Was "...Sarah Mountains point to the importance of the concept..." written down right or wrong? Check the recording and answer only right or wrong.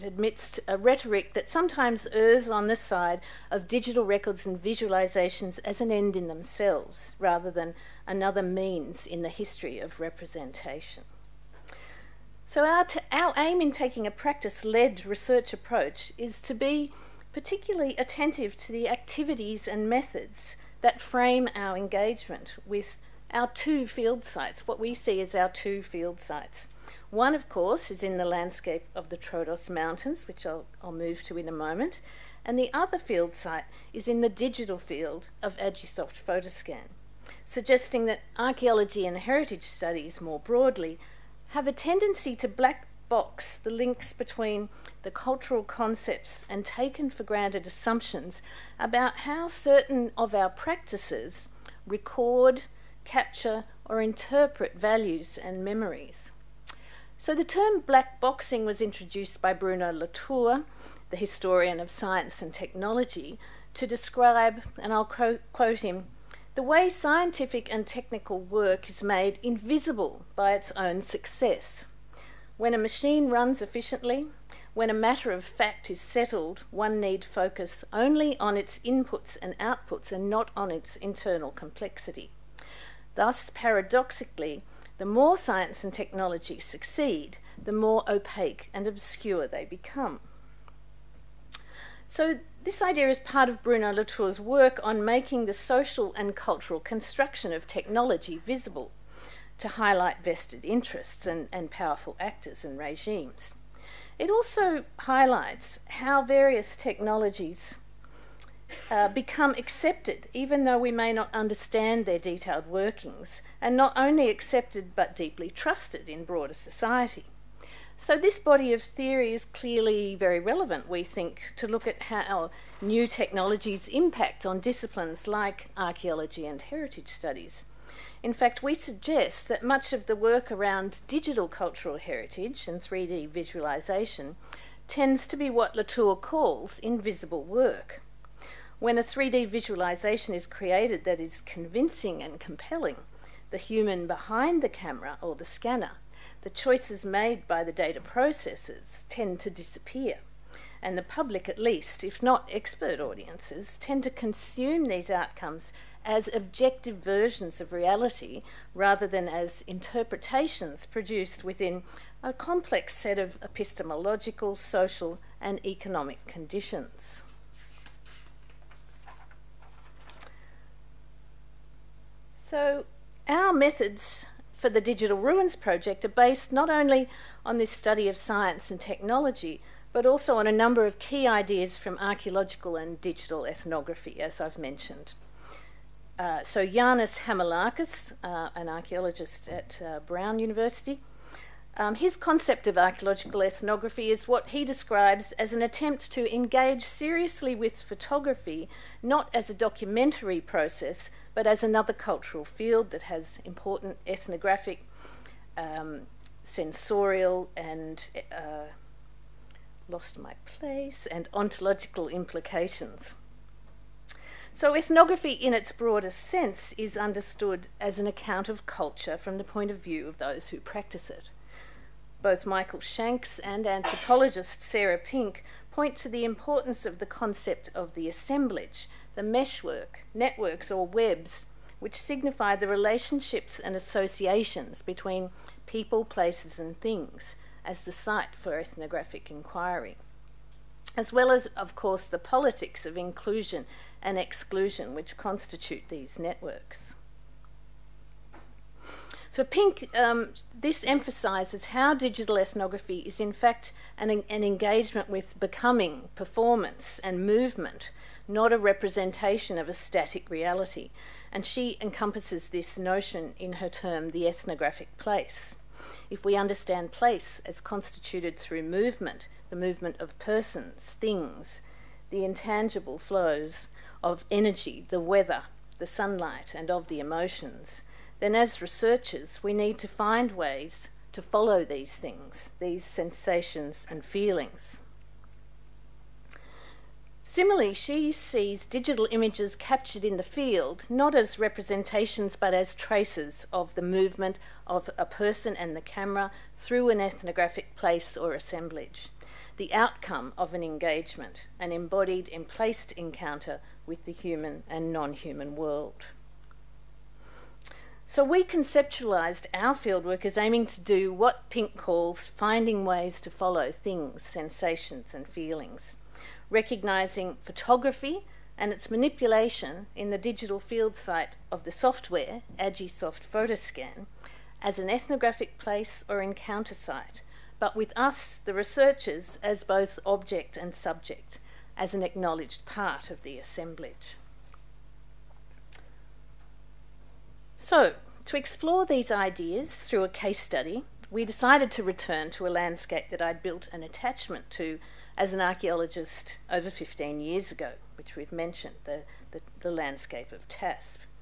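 wrong.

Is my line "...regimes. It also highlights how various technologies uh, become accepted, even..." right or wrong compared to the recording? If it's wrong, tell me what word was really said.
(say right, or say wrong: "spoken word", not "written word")
right.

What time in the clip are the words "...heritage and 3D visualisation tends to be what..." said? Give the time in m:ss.
2:11.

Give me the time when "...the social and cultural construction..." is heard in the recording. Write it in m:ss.
1:35.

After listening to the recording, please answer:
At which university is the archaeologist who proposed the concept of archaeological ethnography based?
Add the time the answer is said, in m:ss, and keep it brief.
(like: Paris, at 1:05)
Brown University, at 3:09.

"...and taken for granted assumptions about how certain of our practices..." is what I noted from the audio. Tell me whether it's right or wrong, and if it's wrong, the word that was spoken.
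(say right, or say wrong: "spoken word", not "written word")
right.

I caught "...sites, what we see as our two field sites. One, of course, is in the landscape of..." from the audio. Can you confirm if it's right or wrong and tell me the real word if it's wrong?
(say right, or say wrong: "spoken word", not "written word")
right.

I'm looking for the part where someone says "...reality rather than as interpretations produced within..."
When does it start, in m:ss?
2:37.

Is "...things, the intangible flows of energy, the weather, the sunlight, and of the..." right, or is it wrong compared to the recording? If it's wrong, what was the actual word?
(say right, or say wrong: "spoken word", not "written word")
right.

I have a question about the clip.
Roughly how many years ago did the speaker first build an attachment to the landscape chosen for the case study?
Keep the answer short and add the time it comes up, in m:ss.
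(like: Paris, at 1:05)
15, at 5:46.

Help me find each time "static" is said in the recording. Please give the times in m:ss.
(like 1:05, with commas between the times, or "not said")
4:19.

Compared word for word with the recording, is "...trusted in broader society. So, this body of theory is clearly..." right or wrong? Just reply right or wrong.
right.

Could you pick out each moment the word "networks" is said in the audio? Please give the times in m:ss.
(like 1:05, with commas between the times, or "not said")
3:50, 4:06.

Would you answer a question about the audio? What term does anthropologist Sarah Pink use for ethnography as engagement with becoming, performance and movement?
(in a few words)
the ethnographic place.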